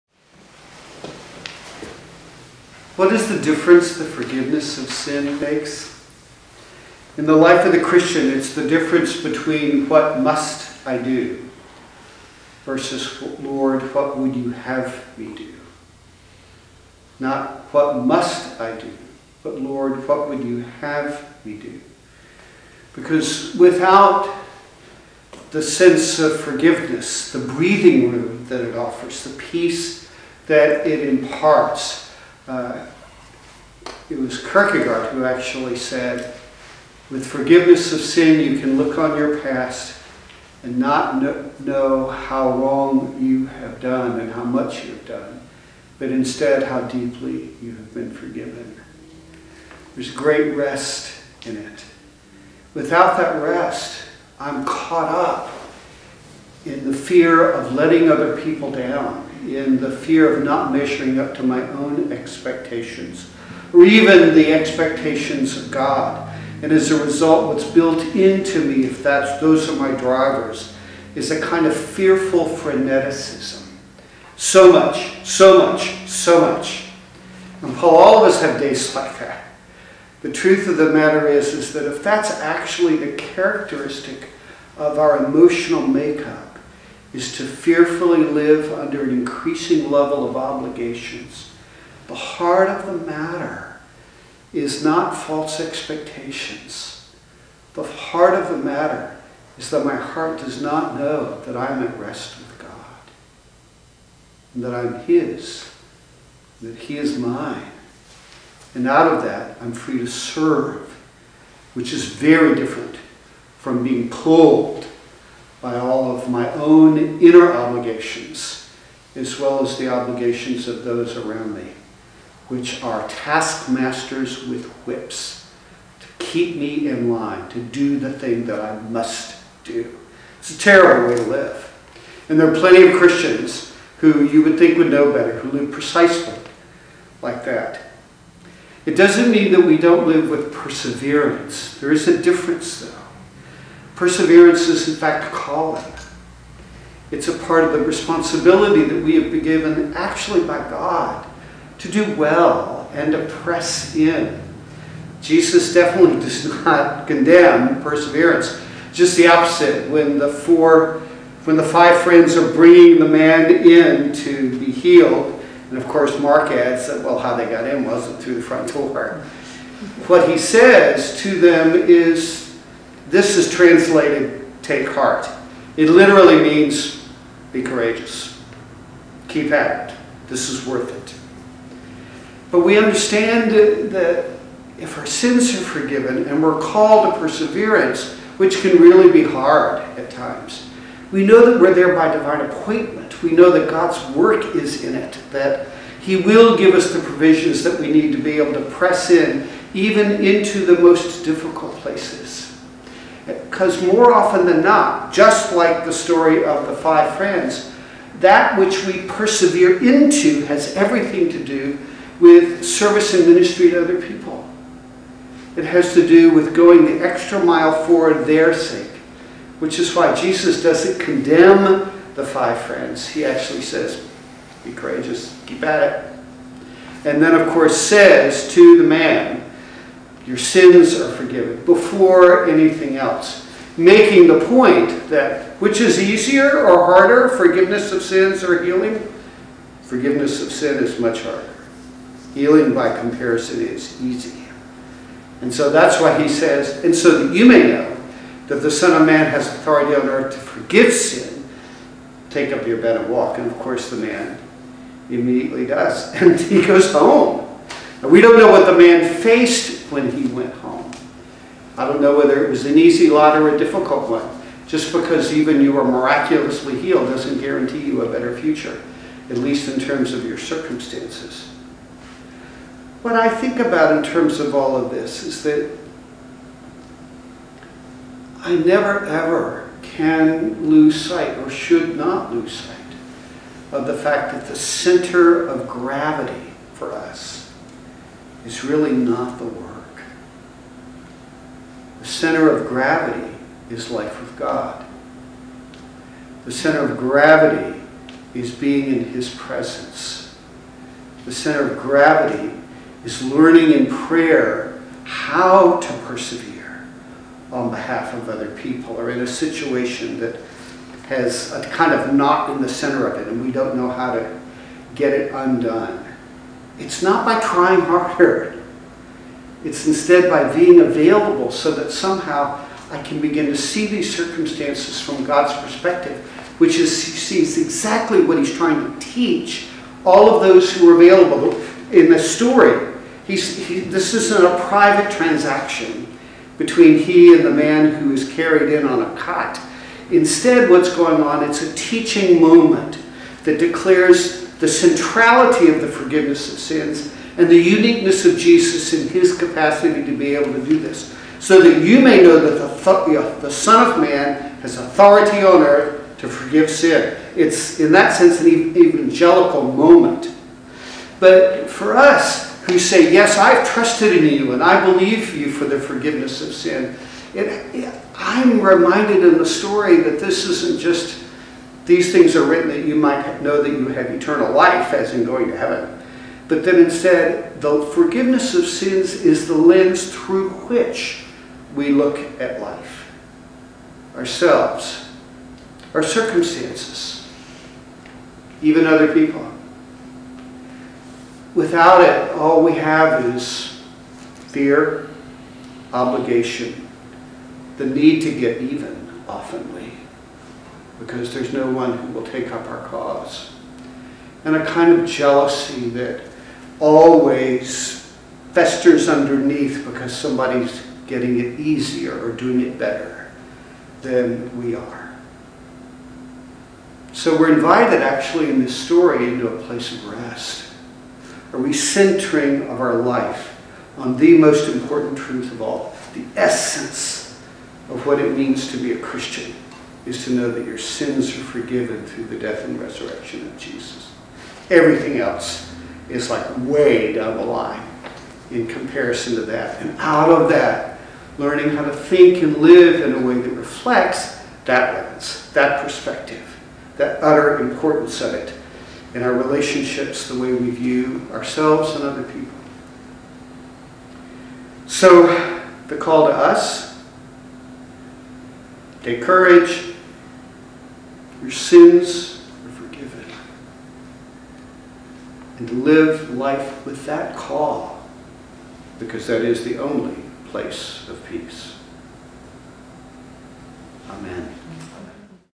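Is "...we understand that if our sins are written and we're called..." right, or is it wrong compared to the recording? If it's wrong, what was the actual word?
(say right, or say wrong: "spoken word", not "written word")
wrong: "forgiven", not "written".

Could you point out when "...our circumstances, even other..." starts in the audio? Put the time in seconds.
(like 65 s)
385 s.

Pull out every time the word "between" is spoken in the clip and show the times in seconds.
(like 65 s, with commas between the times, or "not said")
9 s, 336 s.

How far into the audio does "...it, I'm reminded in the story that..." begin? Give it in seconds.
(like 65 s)
367 s.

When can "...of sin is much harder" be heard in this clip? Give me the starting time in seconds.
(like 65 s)
240 s.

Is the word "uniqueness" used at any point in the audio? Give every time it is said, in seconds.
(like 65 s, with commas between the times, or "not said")
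347 s.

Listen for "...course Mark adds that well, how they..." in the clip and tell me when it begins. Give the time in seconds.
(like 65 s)
165 s.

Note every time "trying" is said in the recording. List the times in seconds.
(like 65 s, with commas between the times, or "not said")
317 s, 328 s.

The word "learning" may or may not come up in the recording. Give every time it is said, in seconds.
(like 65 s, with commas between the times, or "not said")
303 s, 441 s.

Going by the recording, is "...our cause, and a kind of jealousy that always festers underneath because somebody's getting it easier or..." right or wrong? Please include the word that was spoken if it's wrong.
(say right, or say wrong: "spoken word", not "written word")
right.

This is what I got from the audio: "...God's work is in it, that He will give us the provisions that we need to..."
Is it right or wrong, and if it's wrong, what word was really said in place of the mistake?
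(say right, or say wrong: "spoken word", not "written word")
right.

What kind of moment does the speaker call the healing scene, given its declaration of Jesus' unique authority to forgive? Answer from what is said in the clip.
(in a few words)
an evangelical moment.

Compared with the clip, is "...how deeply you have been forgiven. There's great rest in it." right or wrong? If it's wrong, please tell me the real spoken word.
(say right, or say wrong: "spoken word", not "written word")
right.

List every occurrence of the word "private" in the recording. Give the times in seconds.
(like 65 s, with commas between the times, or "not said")
334 s.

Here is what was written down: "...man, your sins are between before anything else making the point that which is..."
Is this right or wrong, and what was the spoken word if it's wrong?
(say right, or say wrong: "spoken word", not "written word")
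wrong: "forgiven", not "between".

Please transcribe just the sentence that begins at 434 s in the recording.
Everything else is like way down the line in comparison to that.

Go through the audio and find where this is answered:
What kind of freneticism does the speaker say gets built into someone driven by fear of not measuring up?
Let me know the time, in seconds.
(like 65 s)
71 s.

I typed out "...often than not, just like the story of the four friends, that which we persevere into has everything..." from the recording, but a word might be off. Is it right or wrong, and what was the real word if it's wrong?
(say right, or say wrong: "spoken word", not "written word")
wrong: "five", not "four".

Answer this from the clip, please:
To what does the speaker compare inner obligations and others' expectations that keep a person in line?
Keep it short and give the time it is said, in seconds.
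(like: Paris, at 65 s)
taskmasters with whips, at 123 s.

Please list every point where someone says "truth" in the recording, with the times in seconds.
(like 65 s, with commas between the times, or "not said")
80 s, 425 s.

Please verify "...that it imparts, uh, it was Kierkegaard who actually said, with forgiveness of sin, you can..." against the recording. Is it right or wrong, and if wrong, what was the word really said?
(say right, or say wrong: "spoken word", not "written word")
right.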